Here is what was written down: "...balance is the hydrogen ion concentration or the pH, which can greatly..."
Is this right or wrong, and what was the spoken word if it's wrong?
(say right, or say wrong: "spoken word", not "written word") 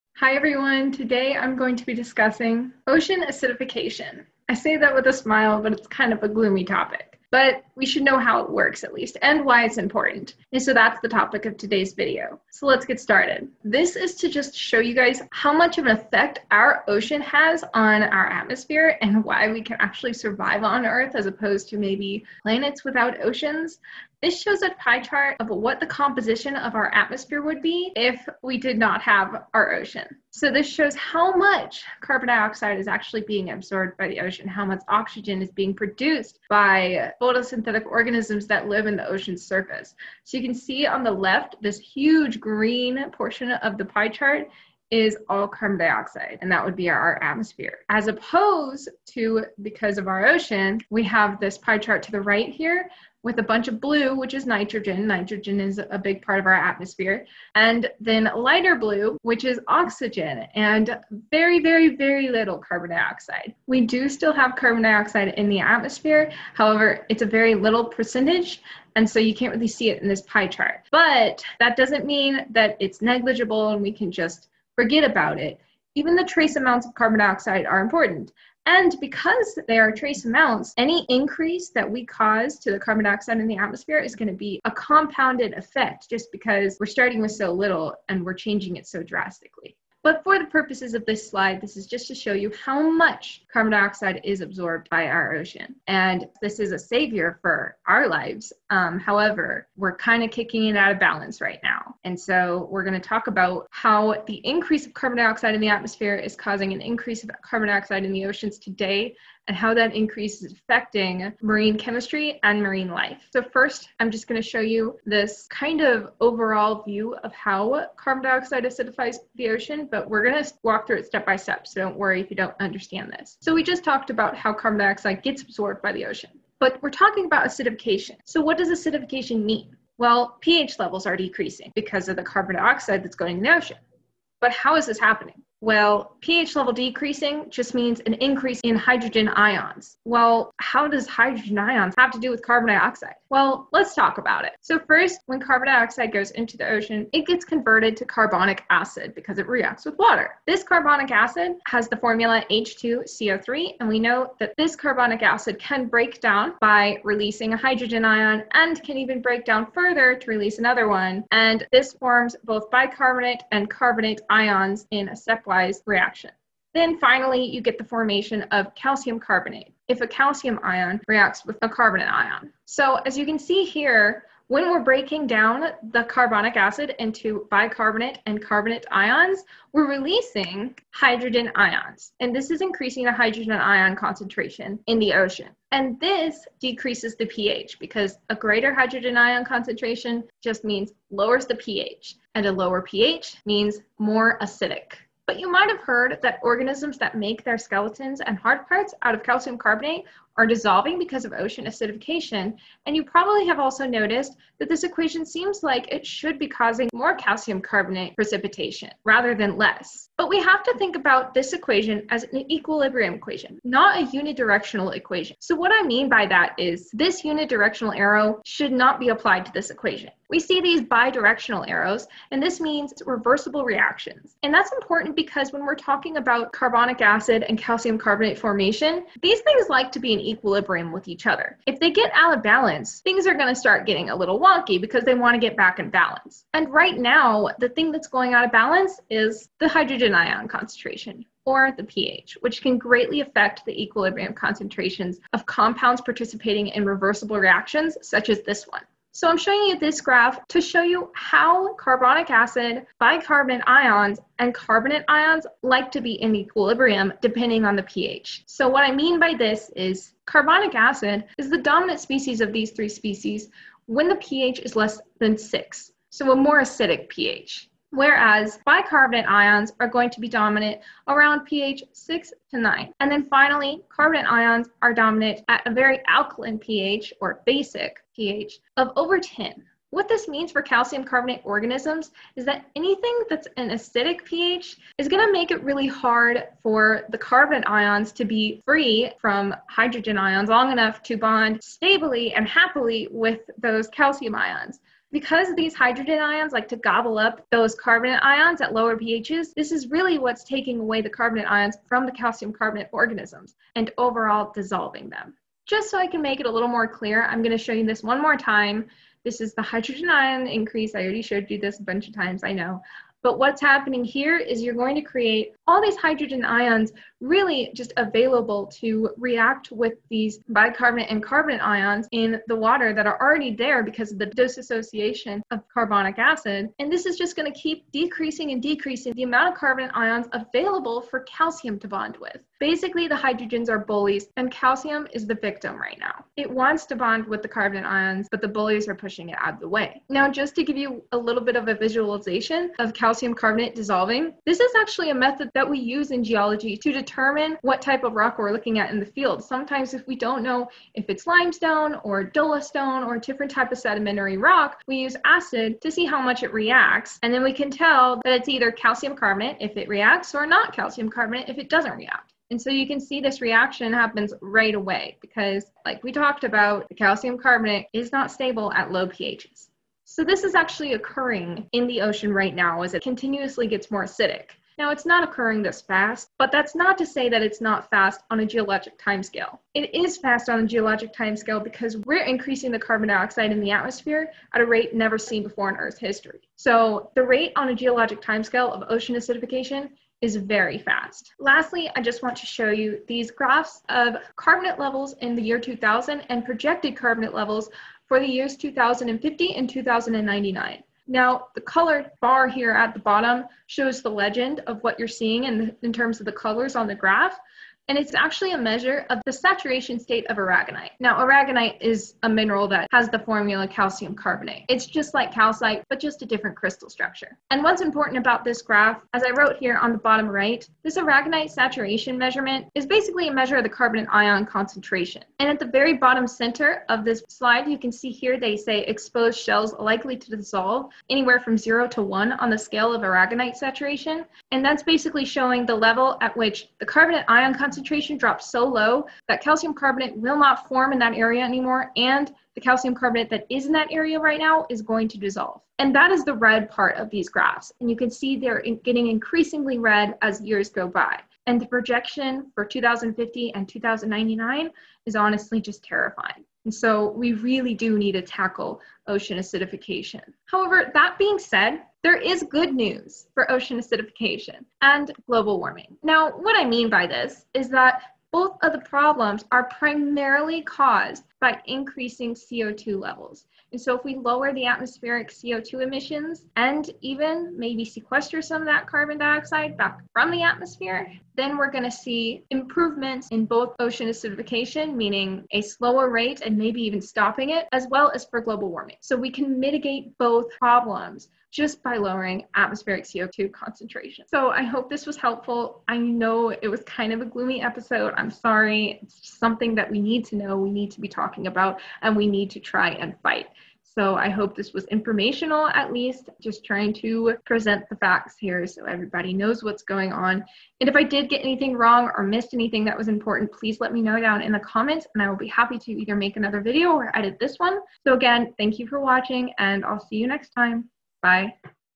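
right.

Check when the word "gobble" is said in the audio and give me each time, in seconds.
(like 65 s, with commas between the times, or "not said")
296 s.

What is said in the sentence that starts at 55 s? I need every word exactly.
Nitrogen is a big part of our atmosphere.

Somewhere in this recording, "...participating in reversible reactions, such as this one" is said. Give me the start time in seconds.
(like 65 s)
246 s.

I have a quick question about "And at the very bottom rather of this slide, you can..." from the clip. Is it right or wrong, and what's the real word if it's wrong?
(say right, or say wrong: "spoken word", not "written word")
wrong: "center", not "rather".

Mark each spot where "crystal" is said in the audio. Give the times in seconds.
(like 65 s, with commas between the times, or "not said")
416 s.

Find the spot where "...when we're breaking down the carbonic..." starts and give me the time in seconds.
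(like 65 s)
174 s.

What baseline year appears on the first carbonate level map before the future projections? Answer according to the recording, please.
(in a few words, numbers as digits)
2000.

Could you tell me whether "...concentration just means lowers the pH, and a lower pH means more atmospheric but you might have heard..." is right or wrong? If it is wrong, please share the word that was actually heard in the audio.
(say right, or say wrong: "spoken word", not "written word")
wrong: "acidic", not "atmospheric".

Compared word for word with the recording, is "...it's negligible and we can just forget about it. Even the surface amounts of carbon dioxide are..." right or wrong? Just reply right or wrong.
wrong.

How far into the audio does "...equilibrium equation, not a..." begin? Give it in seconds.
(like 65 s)
212 s.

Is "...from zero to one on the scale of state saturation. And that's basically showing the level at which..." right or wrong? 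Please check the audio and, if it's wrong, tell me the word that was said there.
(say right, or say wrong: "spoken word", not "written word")
wrong: "aragonite", not "state".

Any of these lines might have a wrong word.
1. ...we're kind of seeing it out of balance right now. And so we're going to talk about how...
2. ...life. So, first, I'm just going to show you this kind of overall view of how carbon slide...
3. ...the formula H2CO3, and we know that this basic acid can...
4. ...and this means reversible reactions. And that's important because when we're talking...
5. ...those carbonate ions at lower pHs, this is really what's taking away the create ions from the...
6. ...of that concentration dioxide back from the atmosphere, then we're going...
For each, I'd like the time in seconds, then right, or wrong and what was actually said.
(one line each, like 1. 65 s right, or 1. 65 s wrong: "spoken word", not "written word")
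1. 99 s wrong: "kicking", not "seeing"
2. 112 s wrong: "dioxide", not "slide"
3. 151 s wrong: "carbonic", not "basic"
4. 222 s right
5. 297 s wrong: "carbonate", not "create"
6. 478 s wrong: "carbon", not "concentration".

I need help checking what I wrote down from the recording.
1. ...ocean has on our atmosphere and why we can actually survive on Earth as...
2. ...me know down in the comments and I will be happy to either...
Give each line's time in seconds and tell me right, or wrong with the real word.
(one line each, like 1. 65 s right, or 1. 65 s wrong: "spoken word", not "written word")
1. 16 s right
2. 513 s right.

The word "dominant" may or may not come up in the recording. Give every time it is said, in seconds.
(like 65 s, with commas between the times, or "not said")
261 s, 270 s, 274 s.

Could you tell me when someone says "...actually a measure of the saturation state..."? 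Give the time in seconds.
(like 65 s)
408 s.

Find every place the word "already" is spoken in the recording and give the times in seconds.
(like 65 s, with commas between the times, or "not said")
311 s, 323 s.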